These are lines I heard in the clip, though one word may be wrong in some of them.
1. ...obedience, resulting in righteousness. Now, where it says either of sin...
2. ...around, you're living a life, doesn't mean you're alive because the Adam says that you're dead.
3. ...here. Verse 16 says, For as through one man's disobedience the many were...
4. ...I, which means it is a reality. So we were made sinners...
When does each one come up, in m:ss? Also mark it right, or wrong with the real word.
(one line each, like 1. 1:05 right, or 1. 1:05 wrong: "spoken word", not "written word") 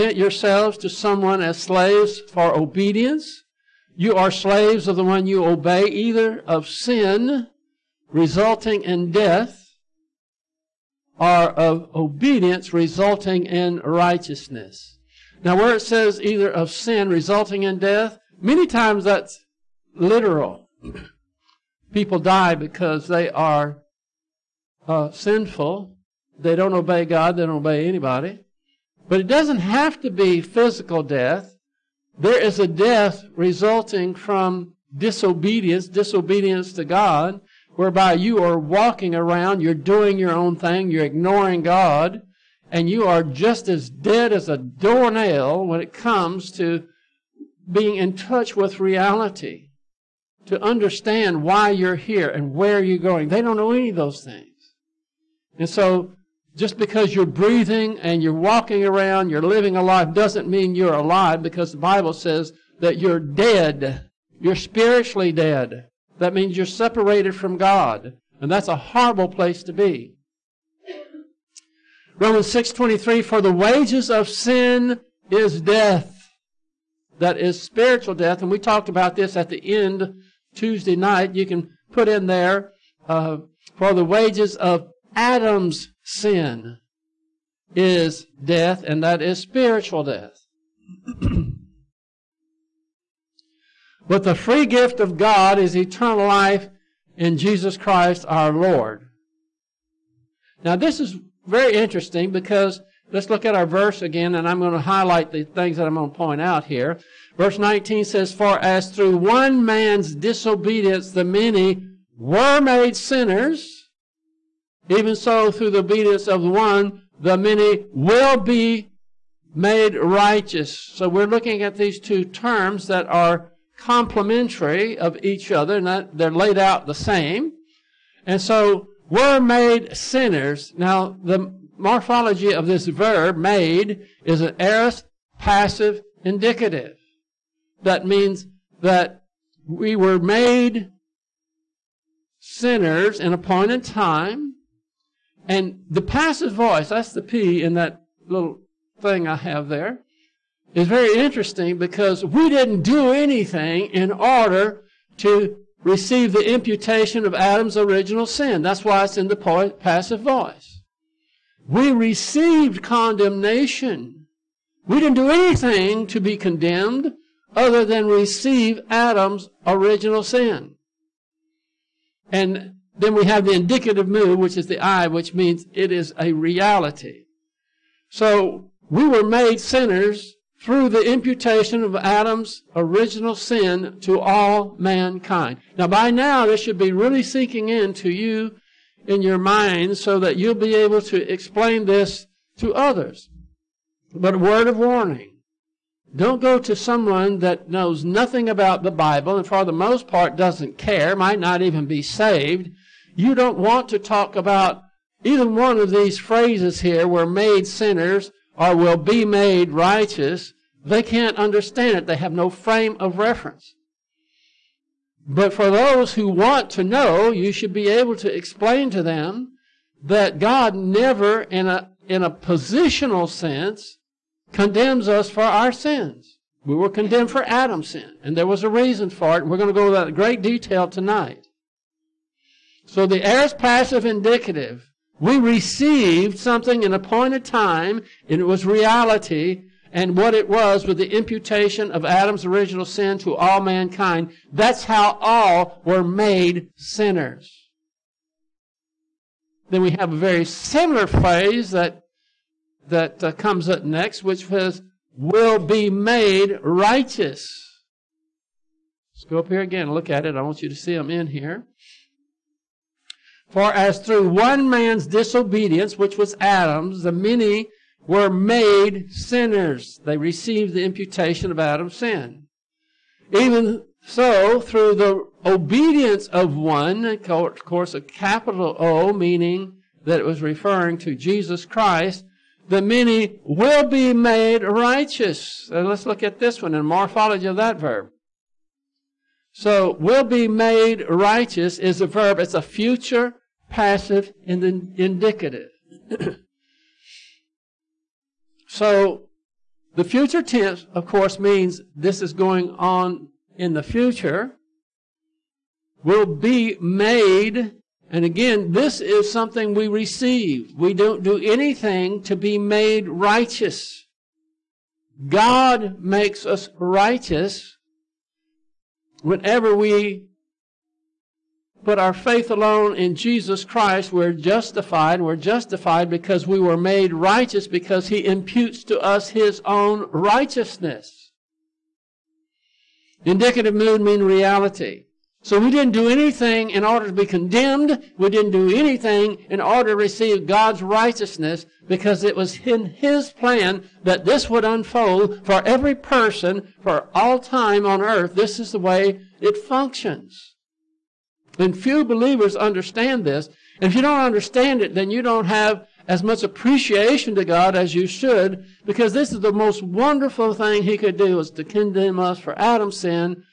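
1. 0:11 right
2. 0:58 wrong: "Bible", not "Adam"
3. 1:46 wrong: "19", not "16"
4. 2:54 right.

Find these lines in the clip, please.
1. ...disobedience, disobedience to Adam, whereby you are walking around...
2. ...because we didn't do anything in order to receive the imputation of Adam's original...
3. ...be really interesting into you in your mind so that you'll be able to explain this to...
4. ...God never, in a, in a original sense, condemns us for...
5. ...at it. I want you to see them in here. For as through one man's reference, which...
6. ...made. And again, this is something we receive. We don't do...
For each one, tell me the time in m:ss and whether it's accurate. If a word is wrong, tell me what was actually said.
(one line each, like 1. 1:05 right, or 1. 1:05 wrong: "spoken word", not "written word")
1. 0:34 wrong: "God", not "Adam"
2. 2:31 right
3. 3:06 wrong: "sinking", not "interesting"
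4. 3:40 wrong: "positional", not "original"
5. 4:20 wrong: "disobedience", not "reference"
6. 5:06 right.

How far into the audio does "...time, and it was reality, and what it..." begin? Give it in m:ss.
3:57.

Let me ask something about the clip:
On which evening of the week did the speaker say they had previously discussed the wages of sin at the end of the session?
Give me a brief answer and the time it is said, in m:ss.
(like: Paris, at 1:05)
Tuesday, at 1:20.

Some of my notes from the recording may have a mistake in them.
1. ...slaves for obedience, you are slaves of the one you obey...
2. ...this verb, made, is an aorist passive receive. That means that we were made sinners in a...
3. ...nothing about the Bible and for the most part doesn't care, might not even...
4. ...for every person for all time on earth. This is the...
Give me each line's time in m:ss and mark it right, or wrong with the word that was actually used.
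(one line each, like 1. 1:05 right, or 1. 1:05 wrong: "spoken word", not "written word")
1. 0:01 right
2. 2:12 wrong: "indicative", not "receive"
3. 3:18 right
4. 5:45 right.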